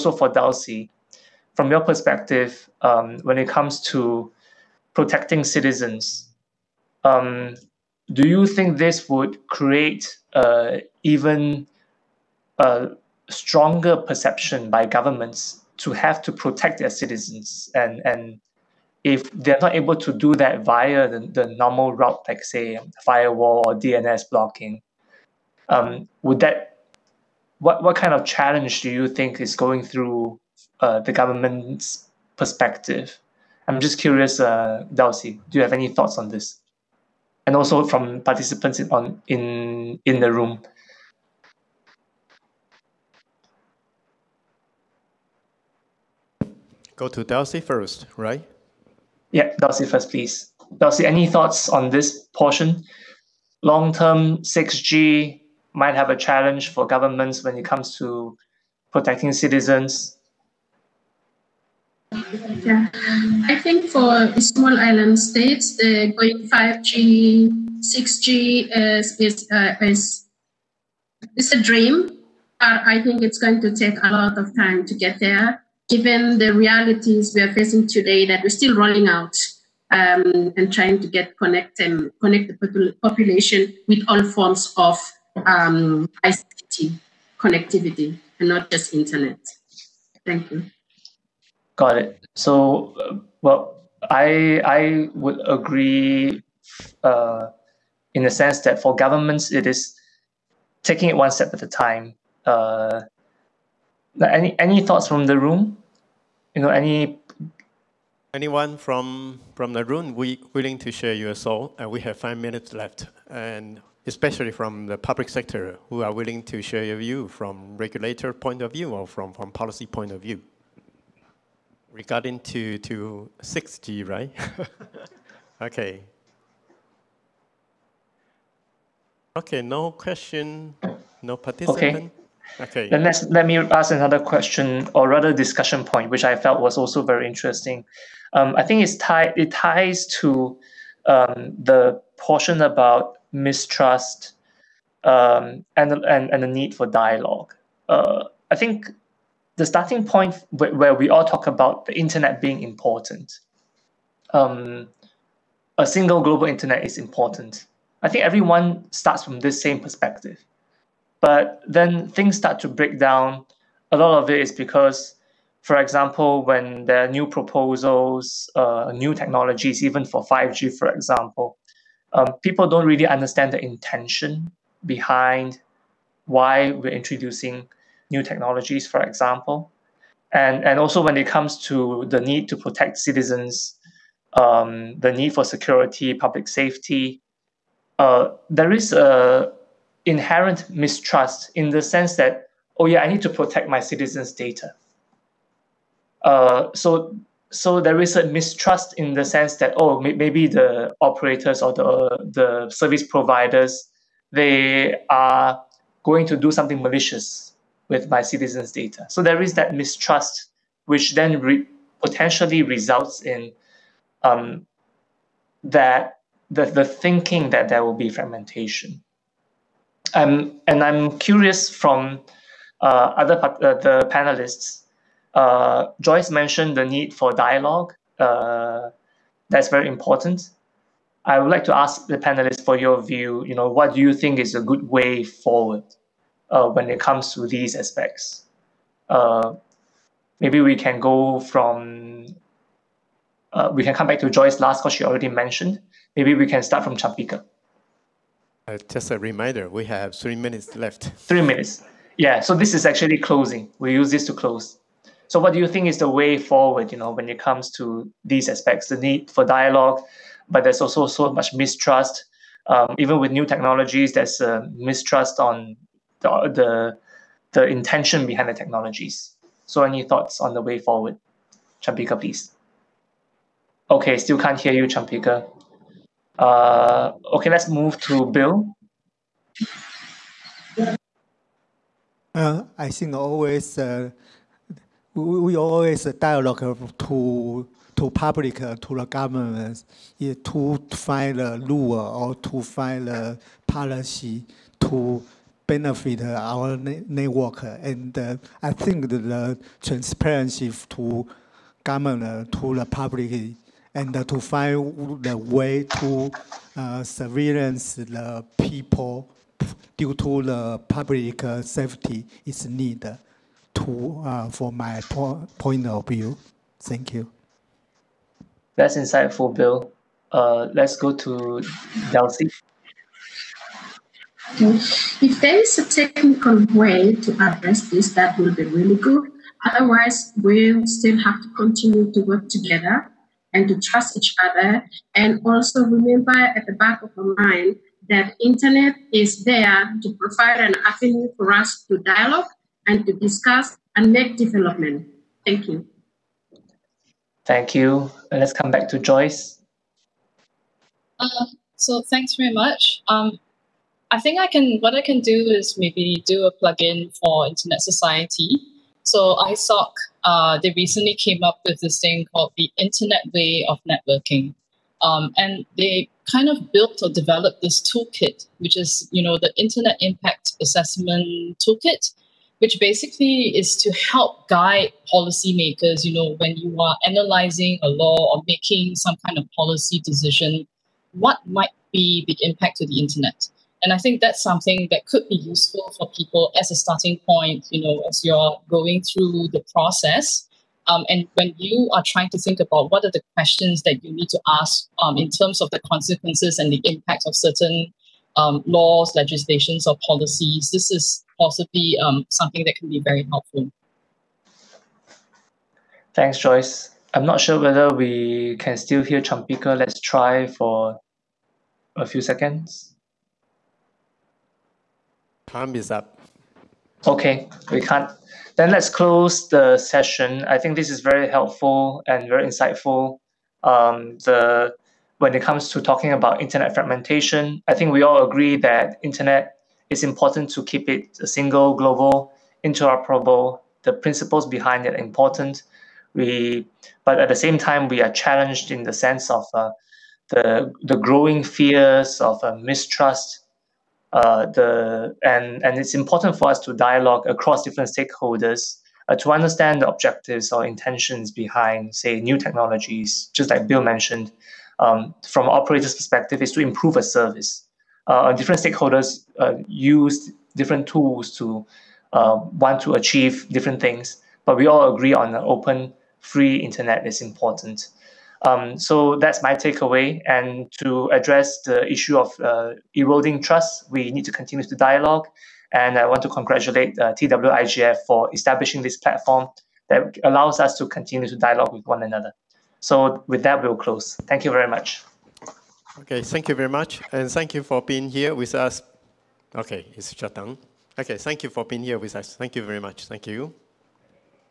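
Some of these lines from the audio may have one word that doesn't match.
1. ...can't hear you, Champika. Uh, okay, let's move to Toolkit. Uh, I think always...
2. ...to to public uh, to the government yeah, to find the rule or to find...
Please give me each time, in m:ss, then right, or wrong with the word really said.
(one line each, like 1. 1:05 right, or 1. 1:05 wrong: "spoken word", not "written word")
1. 4:34 wrong: "Bill", not "Toolkit"
2. 4:46 right.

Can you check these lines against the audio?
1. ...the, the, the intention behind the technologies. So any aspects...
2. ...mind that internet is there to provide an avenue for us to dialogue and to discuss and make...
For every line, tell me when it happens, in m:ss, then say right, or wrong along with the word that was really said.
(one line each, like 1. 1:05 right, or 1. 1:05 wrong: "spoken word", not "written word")
1. 4:26 wrong: "thoughts", not "aspects"
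2. 5:37 right.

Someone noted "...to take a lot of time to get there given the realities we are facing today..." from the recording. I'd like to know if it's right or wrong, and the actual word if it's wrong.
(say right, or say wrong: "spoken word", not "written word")
right.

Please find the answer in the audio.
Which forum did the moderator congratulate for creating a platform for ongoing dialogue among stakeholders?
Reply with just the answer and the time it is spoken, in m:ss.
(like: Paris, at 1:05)
TWIGF, at 7:57.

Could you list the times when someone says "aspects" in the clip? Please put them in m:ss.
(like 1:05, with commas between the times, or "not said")
3:57, 4:18.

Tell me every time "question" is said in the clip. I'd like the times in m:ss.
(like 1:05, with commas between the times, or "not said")
2:09, 2:14, 6:33.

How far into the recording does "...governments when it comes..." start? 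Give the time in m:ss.
0:56.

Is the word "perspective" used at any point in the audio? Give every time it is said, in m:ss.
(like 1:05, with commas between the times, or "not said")
0:01, 0:32, 2:39, 7:35.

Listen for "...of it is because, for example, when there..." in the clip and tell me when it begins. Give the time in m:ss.
2:44.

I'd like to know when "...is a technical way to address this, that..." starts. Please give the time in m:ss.
5:25.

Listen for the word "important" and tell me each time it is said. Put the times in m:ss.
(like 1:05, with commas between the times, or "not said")
2:32, 2:36, 3:49, 7:10, 7:14, 7:25, 7:47.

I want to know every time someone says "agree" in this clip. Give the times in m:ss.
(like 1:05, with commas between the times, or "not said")
1:35, 7:08, 7:44.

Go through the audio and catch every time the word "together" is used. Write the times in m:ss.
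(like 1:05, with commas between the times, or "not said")
5:32.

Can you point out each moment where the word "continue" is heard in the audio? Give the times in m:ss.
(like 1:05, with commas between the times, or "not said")
5:31, 7:54, 8:00.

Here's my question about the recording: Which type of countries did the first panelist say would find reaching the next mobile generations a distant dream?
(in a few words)
small island states.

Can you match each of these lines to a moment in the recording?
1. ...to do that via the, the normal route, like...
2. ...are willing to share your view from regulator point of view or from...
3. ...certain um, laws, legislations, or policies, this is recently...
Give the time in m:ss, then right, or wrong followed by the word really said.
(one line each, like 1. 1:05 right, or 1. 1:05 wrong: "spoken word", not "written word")
1. 0:19 right
2. 1:56 right
3. 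6:37 wrong: "possibly", not "recently".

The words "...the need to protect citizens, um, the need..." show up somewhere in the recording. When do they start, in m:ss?
3:02.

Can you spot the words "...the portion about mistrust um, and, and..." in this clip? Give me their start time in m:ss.
2:21.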